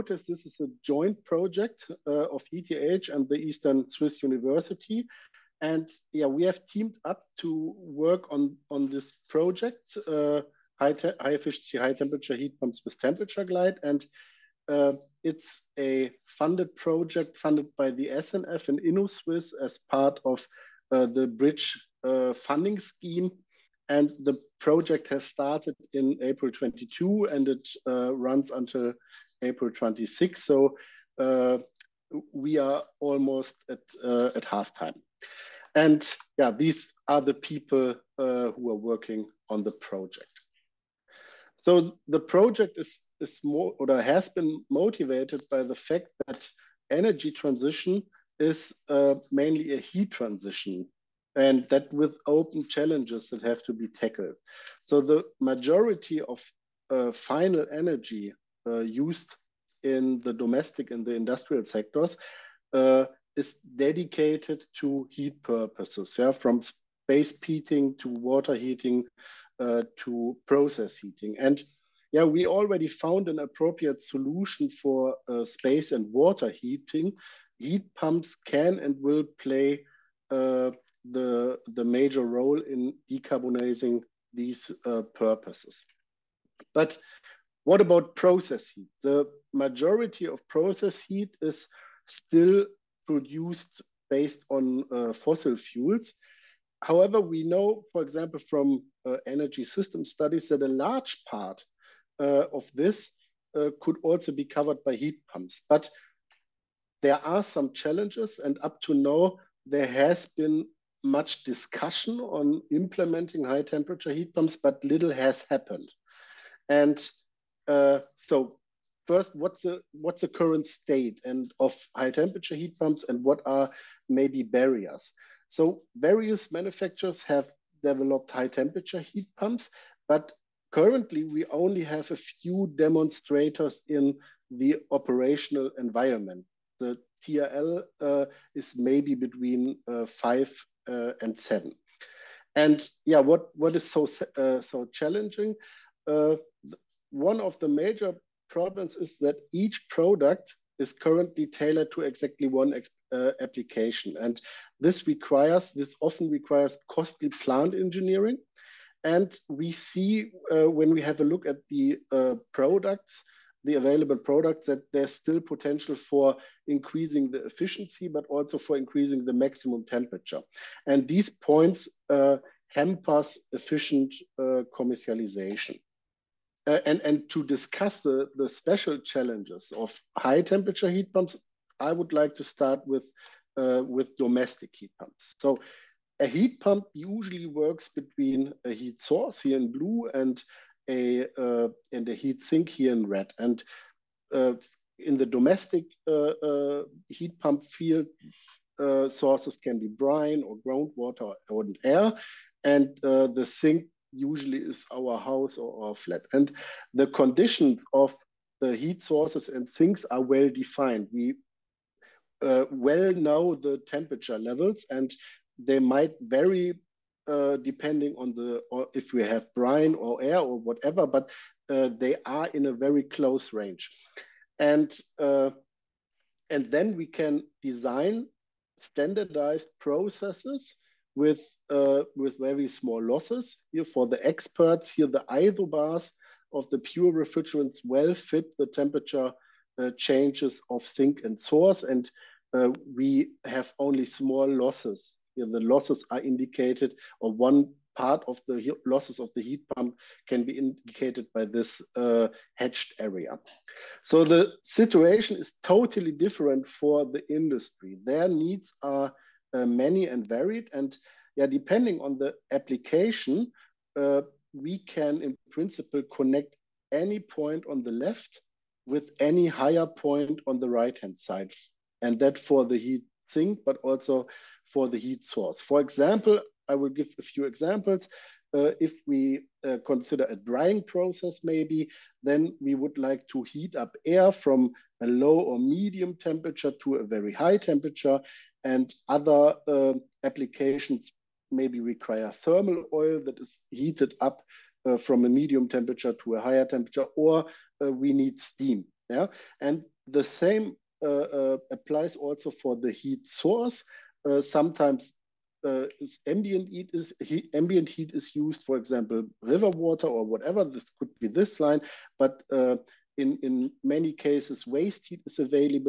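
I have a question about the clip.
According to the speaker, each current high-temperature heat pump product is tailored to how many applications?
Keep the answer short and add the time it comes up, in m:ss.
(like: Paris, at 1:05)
1, at 2:32.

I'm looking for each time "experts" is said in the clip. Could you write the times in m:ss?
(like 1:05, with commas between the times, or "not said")
3:54.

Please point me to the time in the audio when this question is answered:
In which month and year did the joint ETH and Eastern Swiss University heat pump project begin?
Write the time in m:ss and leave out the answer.
0:26.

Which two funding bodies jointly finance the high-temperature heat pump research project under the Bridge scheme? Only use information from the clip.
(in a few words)
SNF and Innosuisse.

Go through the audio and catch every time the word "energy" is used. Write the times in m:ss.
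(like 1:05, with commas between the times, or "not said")
0:46, 0:57, 1:39.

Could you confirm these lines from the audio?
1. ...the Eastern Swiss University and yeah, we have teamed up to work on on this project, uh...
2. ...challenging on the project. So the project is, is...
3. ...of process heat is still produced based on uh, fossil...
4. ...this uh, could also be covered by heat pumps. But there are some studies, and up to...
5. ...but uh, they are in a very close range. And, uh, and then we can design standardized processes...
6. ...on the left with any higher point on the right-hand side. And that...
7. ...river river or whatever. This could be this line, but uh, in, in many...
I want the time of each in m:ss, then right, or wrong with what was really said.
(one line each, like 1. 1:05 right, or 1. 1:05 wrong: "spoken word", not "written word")
1. 0:03 right
2. 0:38 wrong: "working", not "challenging"
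3. 1:30 right
4. 1:42 wrong: "challenges", not "studies"
5. 3:41 right
6. 4:27 right
7. 5:09 wrong: "water", not "river".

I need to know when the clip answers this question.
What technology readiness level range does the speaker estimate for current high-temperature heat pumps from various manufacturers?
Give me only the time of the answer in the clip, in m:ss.
2:19.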